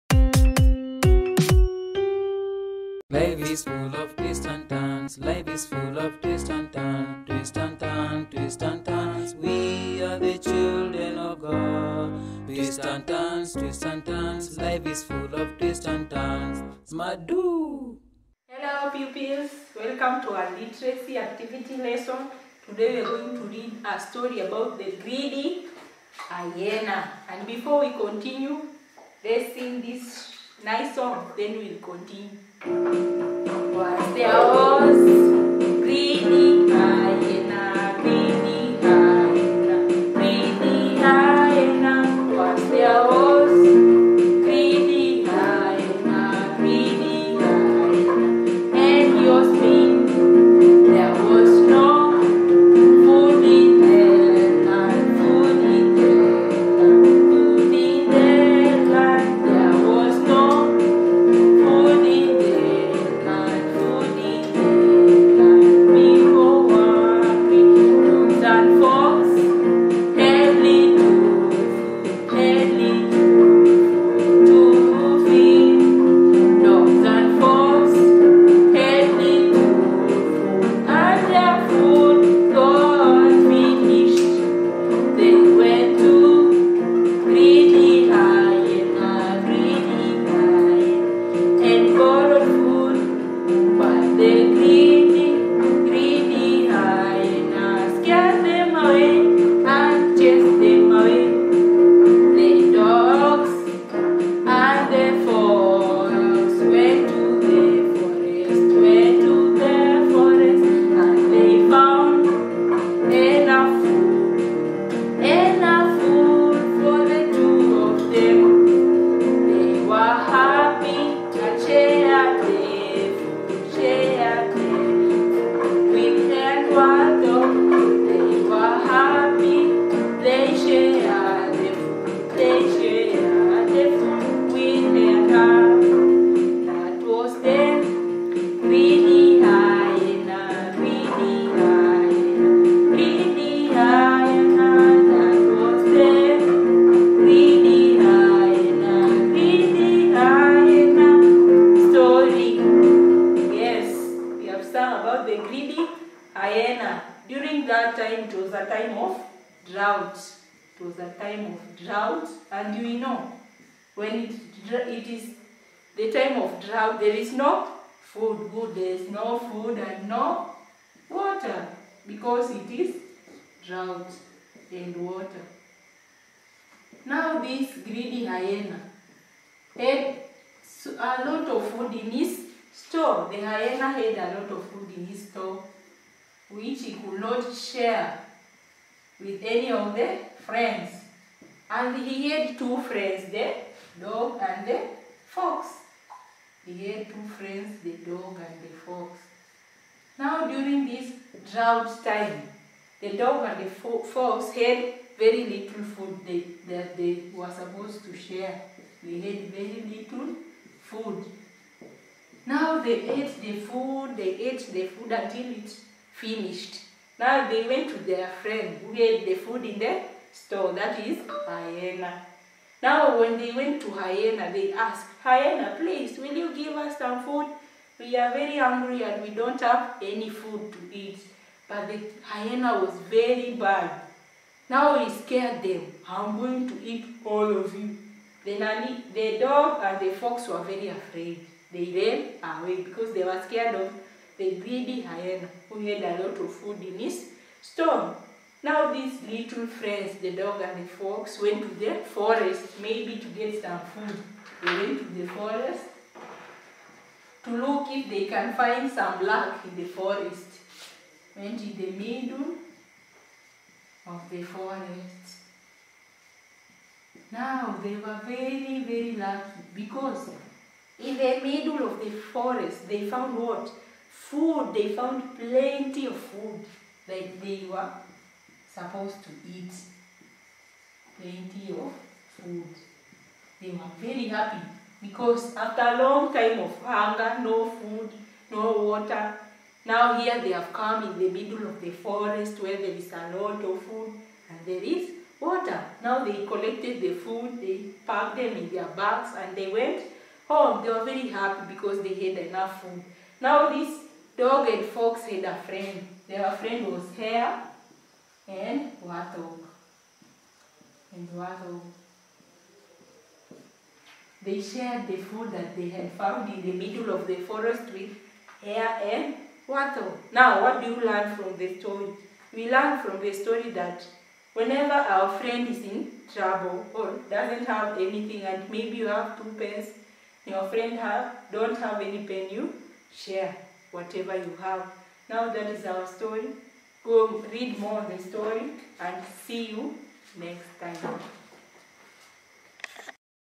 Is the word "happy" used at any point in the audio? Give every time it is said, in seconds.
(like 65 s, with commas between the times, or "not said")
284 s, 301 s.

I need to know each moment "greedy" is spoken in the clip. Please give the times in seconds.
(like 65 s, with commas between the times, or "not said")
25 s, 177 s, 244 s.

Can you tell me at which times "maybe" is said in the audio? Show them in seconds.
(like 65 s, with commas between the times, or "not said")
252 s, 328 s.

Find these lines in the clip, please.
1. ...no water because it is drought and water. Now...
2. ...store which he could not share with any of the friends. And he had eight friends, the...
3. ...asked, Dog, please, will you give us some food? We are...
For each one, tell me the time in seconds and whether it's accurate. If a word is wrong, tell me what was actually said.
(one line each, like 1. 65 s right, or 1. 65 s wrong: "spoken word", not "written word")
1. 170 s right
2. 185 s wrong: "two", not "eight"
3. 224 s wrong: "Hyena", not "Dog".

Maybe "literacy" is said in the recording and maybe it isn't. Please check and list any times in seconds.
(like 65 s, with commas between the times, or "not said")
20 s.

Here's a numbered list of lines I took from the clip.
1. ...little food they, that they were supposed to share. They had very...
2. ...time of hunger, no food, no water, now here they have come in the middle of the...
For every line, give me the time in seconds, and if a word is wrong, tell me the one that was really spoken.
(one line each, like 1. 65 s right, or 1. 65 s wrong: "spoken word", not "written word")
1. 205 s right
2. 286 s right.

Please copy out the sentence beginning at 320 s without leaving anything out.
Now, what do you learn from the story?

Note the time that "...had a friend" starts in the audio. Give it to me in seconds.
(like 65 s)
305 s.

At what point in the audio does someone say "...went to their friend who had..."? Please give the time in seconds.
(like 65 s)
217 s.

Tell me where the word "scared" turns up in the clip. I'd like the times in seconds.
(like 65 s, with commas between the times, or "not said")
235 s, 243 s.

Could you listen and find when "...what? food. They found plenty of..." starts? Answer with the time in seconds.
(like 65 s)
273 s.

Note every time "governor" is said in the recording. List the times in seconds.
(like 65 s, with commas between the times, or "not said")
not said.